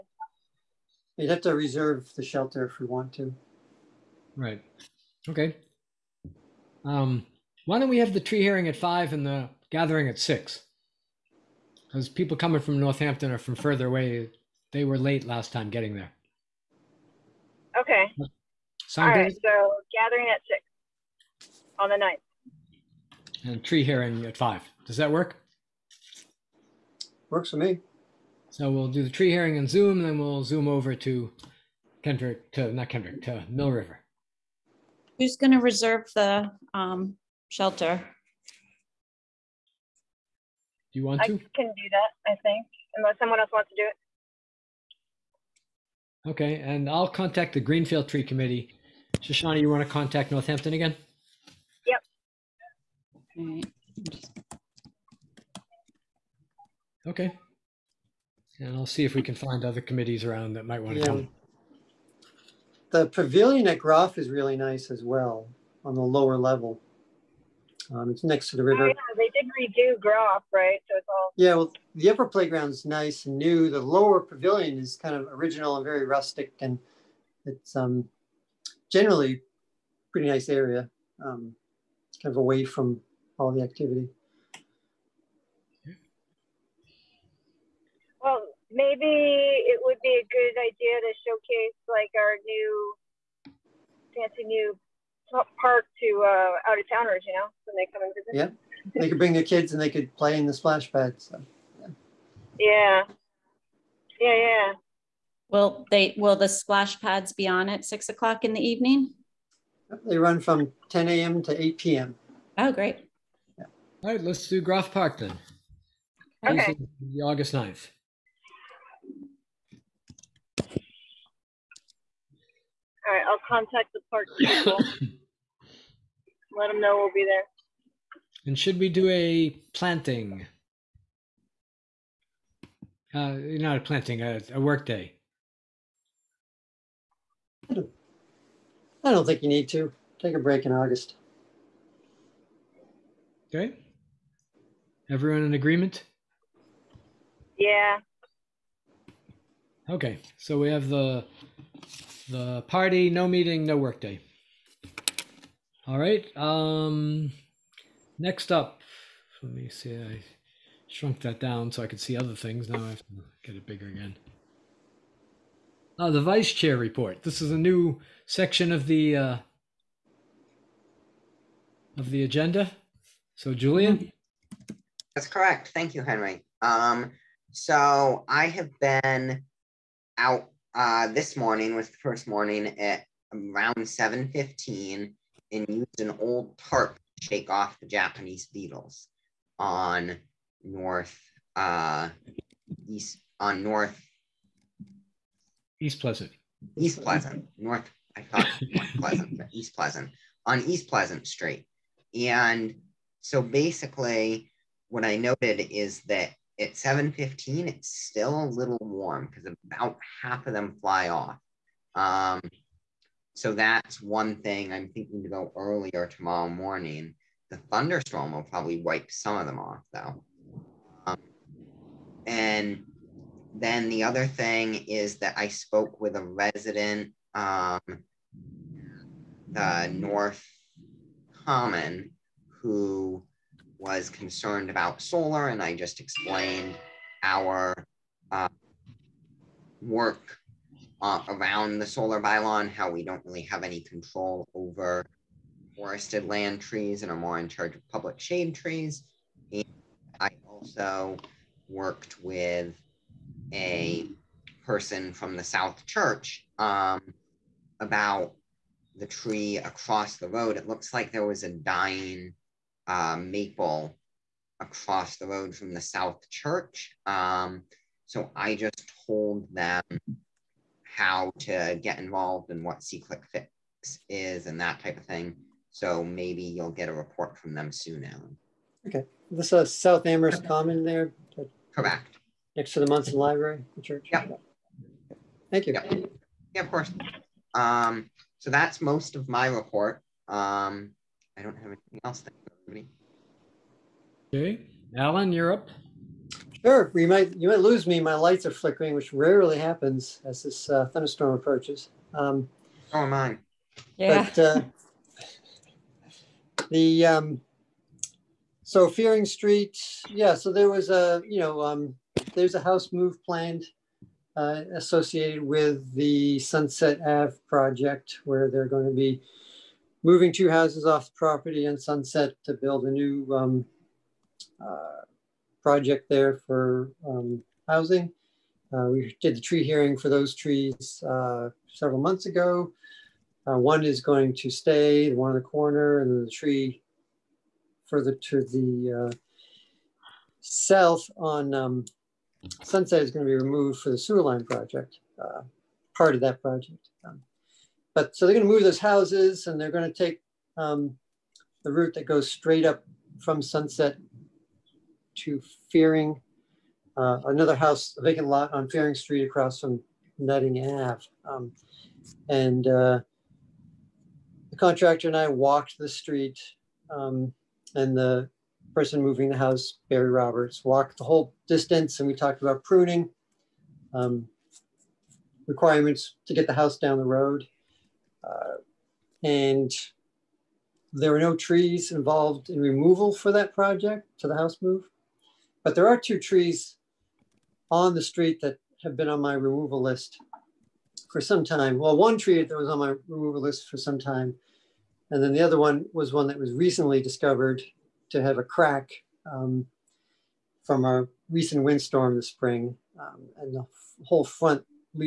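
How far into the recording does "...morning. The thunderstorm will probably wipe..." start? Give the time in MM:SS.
03:36.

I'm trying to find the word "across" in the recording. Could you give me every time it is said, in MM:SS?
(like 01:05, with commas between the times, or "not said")
04:19, 04:24, 05:59.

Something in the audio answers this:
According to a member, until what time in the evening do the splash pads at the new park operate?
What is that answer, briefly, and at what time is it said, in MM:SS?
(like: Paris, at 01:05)
8 p.m., at 01:51.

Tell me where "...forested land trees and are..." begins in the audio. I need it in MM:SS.
04:05.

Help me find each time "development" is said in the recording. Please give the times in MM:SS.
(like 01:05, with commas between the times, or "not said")
not said.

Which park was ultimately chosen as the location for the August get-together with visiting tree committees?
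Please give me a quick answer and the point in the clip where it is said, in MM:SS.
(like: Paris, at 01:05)
Groff Park, at 01:54.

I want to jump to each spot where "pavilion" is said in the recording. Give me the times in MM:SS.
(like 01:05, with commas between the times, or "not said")
01:03, 01:14.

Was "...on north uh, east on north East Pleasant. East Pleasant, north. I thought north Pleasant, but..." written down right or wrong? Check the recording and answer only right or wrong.
right.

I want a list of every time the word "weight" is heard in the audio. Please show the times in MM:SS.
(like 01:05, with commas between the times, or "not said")
not said.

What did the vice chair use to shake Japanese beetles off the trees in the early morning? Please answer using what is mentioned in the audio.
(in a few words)
an old tarp.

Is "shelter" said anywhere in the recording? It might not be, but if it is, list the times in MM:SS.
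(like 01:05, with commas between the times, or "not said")
00:02, 00:37.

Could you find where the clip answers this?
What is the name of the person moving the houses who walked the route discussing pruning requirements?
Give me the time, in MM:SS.
06:09.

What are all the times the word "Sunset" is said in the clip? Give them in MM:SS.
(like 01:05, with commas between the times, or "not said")
05:16, 05:21, 05:42, 05:53.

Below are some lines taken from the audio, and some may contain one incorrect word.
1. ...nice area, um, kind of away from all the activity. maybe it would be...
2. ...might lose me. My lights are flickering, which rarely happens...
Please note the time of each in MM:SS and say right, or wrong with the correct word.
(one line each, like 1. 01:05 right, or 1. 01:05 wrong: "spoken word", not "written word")
1. 01:20 right
2. 04:57 right.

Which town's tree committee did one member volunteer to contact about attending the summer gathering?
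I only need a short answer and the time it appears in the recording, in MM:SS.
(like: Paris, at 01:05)
Greenfield, at 00:47.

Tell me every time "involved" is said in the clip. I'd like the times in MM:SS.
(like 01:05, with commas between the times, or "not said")
04:31, 06:21.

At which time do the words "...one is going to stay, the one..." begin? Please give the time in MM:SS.
05:33.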